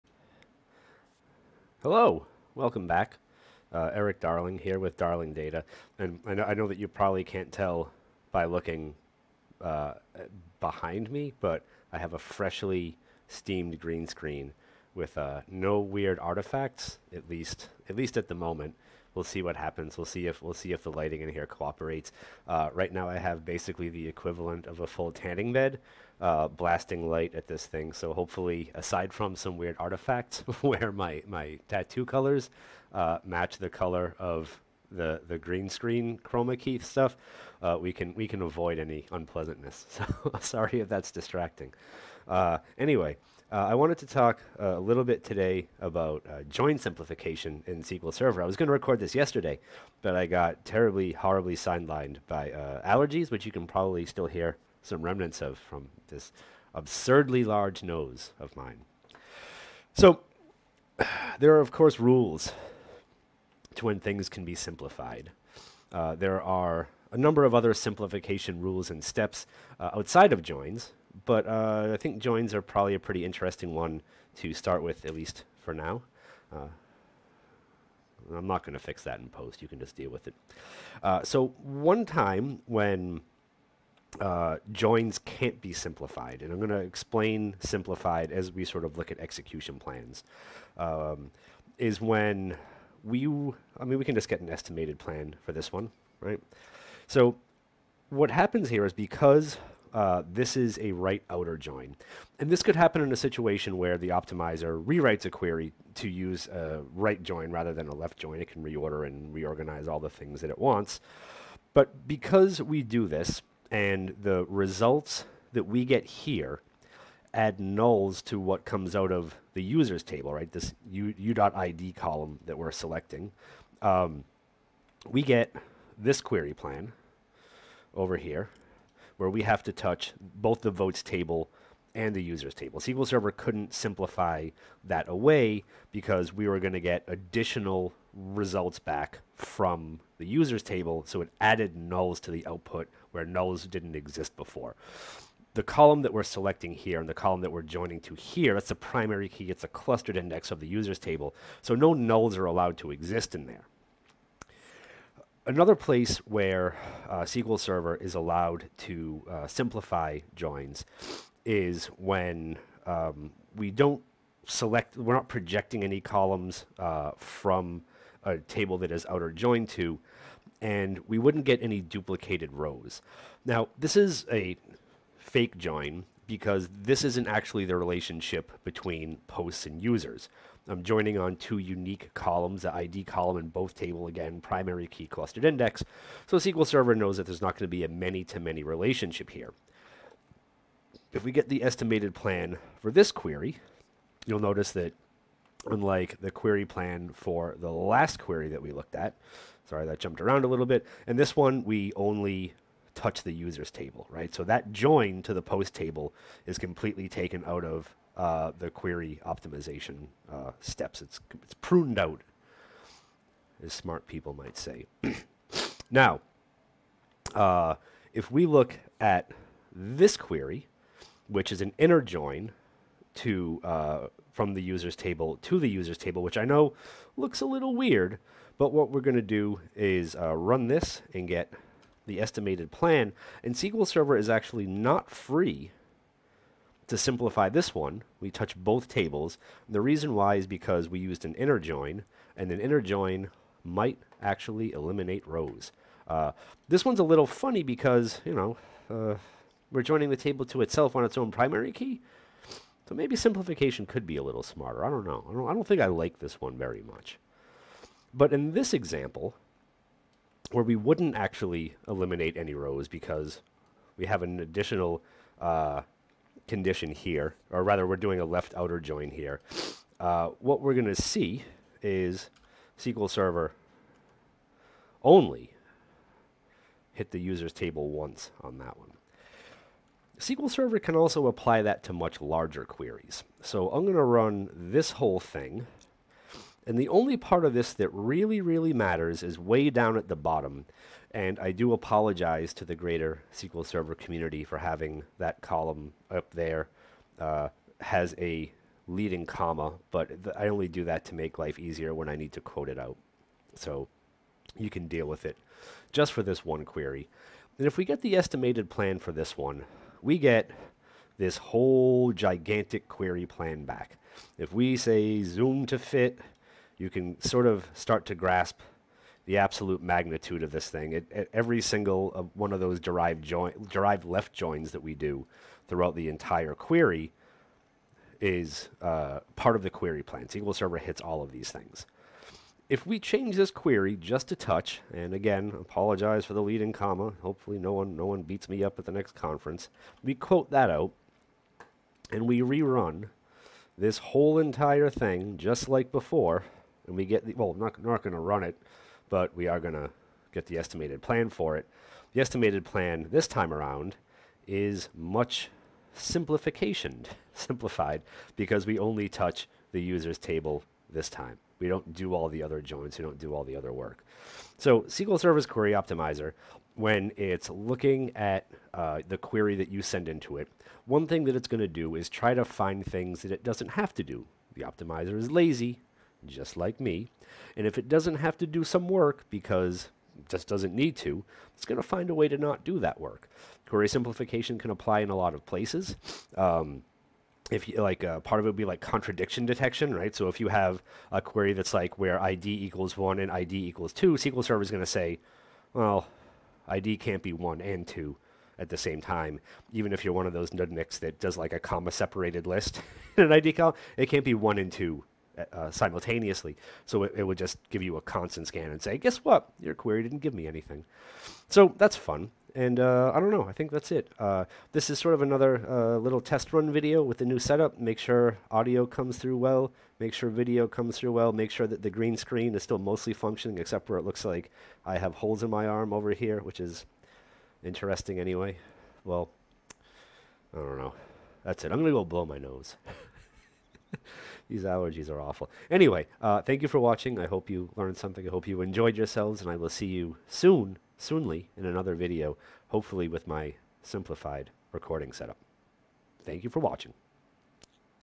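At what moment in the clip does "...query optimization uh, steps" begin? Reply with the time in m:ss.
3:28.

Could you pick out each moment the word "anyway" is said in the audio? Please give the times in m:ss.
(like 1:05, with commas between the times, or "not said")
0:42, 7:08, 7:15.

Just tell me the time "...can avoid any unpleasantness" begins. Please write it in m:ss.
0:38.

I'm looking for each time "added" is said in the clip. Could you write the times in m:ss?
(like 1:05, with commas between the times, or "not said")
2:21.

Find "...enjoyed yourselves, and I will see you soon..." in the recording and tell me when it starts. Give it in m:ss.
7:18.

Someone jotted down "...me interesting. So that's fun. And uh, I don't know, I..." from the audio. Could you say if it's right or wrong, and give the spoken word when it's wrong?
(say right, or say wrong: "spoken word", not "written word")
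wrong: "anything", not "interesting".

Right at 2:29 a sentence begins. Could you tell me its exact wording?
It's a clustered index of the users table.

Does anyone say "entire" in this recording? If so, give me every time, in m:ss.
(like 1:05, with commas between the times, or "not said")
5:26, 5:44.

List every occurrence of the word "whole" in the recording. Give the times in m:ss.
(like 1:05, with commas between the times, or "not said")
4:44, 5:11, 5:43.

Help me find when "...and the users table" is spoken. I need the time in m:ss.
2:11.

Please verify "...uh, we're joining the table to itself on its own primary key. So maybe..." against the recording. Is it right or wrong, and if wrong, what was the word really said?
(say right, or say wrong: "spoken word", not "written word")
right.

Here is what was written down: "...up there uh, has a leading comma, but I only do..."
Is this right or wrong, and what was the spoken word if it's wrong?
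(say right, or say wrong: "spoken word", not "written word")
right.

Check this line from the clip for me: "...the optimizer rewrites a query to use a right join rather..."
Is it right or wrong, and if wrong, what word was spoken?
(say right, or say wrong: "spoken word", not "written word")
right.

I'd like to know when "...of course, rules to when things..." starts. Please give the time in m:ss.
1:01.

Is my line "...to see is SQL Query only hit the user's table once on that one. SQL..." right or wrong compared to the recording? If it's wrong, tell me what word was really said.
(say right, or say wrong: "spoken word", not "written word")
wrong: "Server", not "Query".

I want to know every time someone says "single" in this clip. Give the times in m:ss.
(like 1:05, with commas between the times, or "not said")
5:21.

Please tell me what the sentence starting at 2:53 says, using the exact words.
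Now, this is a fake join because this isn't actually the relationship between posts and users.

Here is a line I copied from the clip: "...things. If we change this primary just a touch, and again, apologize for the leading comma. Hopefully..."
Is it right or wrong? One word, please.
wrong.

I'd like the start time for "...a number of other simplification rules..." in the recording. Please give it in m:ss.
1:07.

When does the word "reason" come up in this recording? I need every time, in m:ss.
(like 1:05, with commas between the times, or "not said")
3:59.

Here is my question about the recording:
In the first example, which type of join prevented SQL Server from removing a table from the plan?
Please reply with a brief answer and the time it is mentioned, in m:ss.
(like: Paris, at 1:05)
right outer join, at 1:40.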